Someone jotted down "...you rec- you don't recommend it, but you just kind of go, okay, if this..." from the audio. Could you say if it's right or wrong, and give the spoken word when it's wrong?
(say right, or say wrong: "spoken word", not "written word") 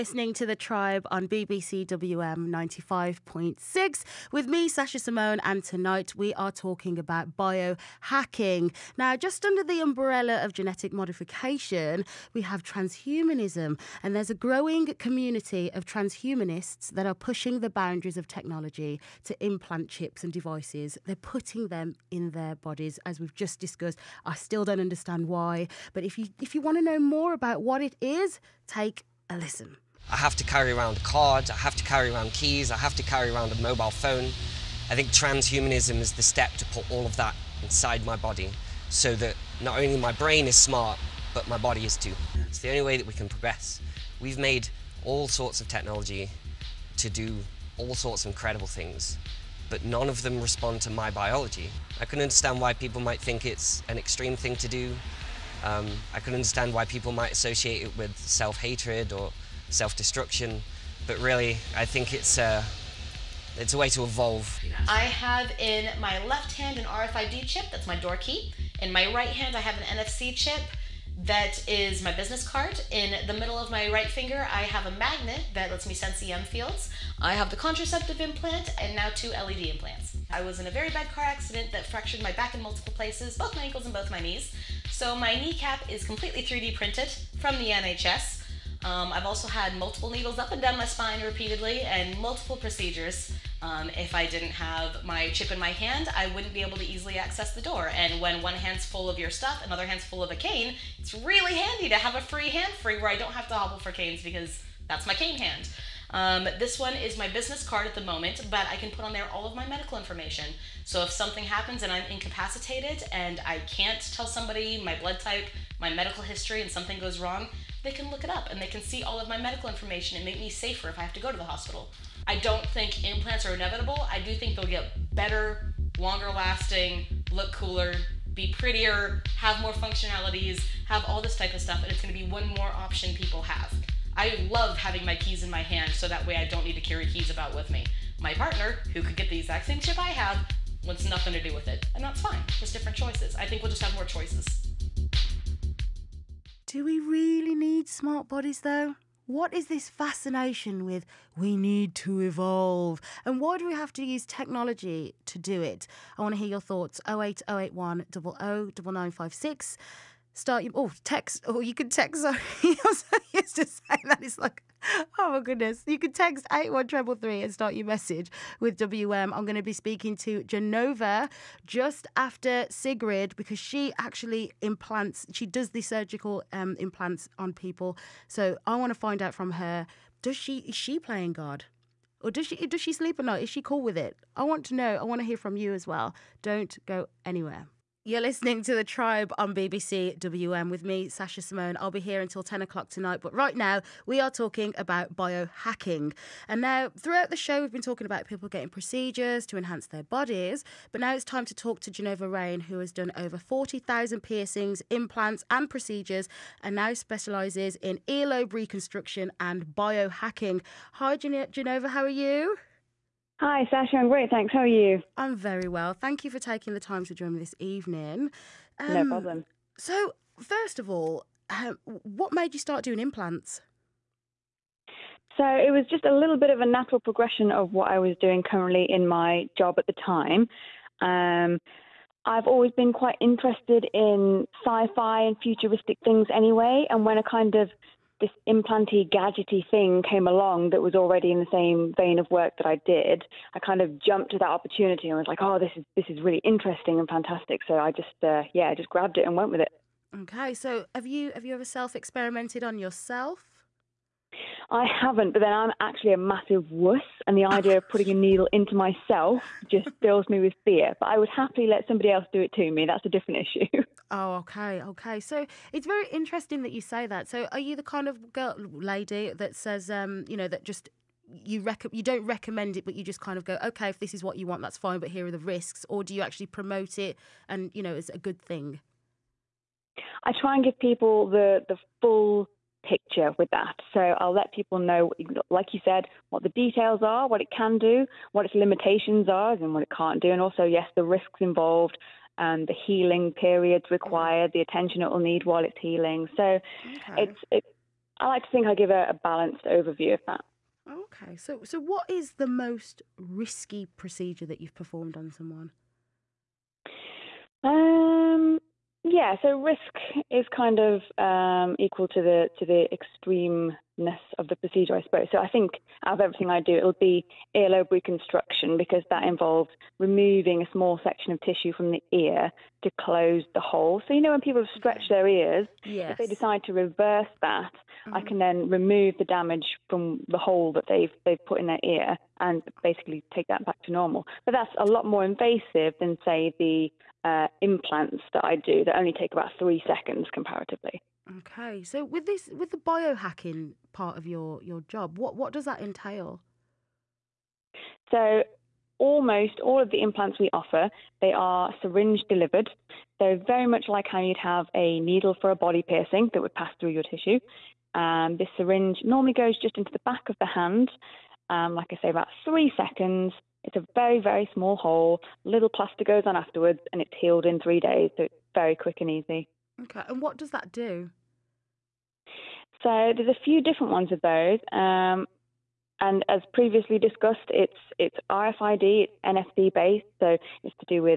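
right.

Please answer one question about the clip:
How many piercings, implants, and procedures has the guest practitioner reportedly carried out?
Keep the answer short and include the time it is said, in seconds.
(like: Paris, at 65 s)
40,000, at 203 s.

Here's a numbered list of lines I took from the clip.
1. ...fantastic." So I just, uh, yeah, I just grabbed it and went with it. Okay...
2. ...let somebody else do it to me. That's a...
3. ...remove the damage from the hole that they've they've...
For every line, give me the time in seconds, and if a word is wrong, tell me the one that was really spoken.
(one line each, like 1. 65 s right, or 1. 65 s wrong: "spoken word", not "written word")
1. 247 s right
2. 261 s right
3. 328 s right.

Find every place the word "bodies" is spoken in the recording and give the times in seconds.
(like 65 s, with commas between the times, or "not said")
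22 s, 148 s, 200 s.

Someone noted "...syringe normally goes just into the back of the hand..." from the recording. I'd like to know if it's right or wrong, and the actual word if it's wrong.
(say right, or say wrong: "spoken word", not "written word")
right.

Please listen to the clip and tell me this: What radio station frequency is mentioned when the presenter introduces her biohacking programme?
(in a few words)
95.6.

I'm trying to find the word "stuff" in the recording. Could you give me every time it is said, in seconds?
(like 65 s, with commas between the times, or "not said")
99 s, 131 s.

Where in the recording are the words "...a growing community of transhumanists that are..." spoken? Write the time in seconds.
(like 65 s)
14 s.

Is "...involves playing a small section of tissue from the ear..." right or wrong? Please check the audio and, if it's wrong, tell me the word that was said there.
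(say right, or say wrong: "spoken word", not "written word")
wrong: "removing", not "playing".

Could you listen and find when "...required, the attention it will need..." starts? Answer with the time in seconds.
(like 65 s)
293 s.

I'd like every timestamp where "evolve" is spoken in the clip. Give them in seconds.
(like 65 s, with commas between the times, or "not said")
64 s, 152 s.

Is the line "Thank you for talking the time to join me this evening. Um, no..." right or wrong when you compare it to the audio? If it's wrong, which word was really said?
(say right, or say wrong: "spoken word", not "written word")
wrong: "taking", not "talking".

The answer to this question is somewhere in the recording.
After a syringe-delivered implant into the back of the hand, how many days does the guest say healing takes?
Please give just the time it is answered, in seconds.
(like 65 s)
367 s.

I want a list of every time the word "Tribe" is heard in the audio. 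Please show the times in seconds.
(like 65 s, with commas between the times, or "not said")
0 s, 188 s.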